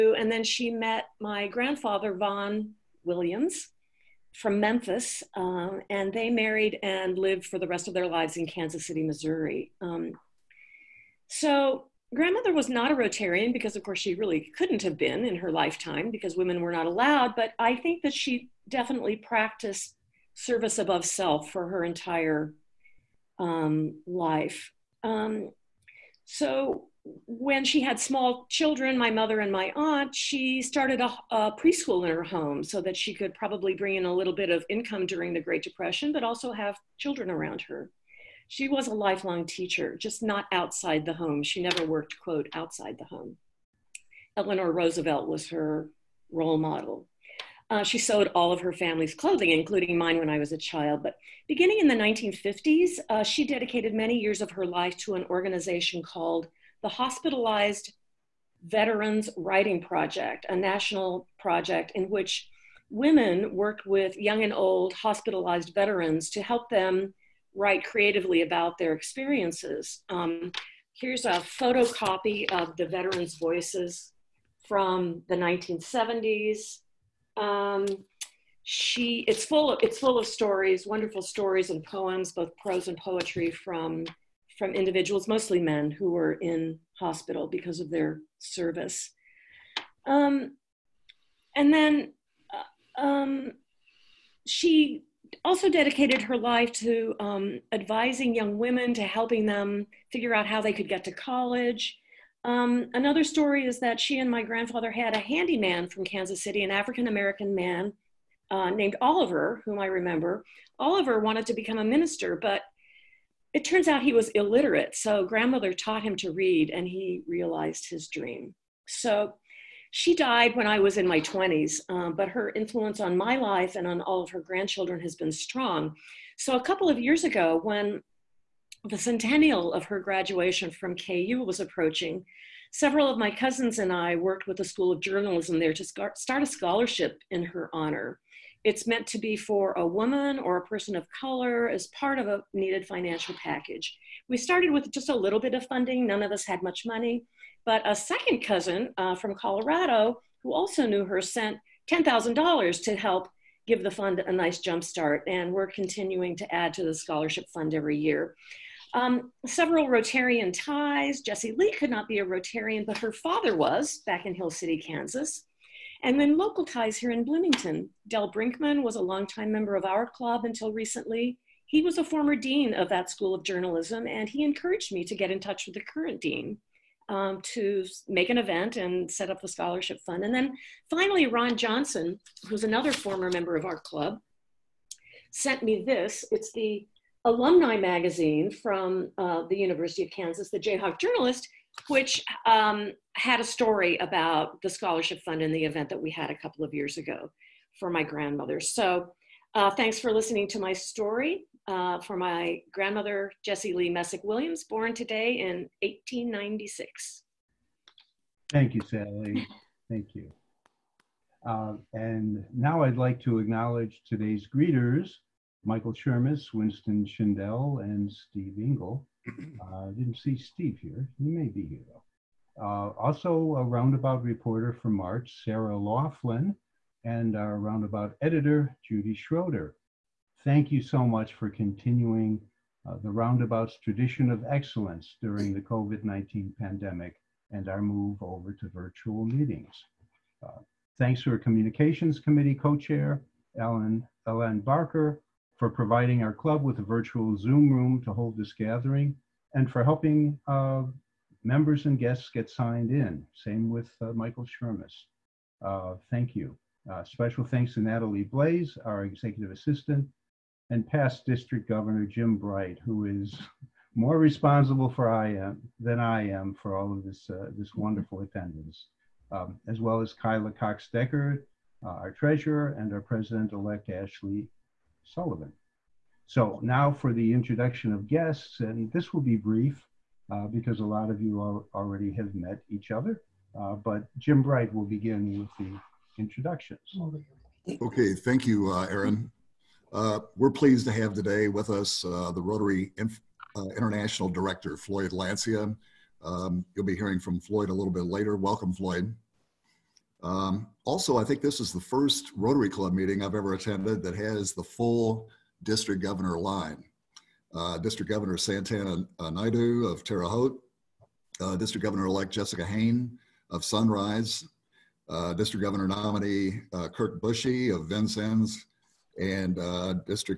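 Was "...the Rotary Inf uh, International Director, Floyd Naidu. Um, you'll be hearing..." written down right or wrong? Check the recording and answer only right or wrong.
wrong.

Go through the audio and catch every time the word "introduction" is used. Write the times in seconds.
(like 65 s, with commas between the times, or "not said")
277 s, 286 s.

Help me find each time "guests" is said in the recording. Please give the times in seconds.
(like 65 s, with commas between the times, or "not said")
251 s, 278 s.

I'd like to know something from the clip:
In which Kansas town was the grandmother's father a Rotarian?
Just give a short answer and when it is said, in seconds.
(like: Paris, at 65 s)
Hill City, at 164 s.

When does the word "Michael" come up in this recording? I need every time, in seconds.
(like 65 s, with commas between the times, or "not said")
215 s, 254 s.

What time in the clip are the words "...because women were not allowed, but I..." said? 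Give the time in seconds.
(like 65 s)
16 s.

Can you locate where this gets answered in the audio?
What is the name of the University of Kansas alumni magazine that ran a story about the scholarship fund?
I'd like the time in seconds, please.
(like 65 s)
190 s.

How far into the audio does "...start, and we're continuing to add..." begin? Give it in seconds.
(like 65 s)
154 s.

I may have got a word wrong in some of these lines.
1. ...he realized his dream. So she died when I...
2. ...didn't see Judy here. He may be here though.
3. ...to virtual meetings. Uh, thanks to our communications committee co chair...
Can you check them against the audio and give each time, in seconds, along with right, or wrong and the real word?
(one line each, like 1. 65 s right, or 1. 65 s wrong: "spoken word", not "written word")
1. 116 s right
2. 219 s wrong: "Steve", not "Judy"
3. 238 s right.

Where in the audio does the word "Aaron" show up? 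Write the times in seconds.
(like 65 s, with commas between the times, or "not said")
288 s.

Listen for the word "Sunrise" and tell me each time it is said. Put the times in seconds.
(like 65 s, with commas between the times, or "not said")
313 s.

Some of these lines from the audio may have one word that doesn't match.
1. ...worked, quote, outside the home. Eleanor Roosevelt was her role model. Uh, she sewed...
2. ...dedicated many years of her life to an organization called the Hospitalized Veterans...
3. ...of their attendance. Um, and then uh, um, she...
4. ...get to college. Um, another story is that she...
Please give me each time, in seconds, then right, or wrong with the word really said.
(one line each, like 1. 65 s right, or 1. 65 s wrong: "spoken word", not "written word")
1. 41 s right
2. 53 s right
3. 87 s wrong: "service", not "attendance"
4. 100 s right.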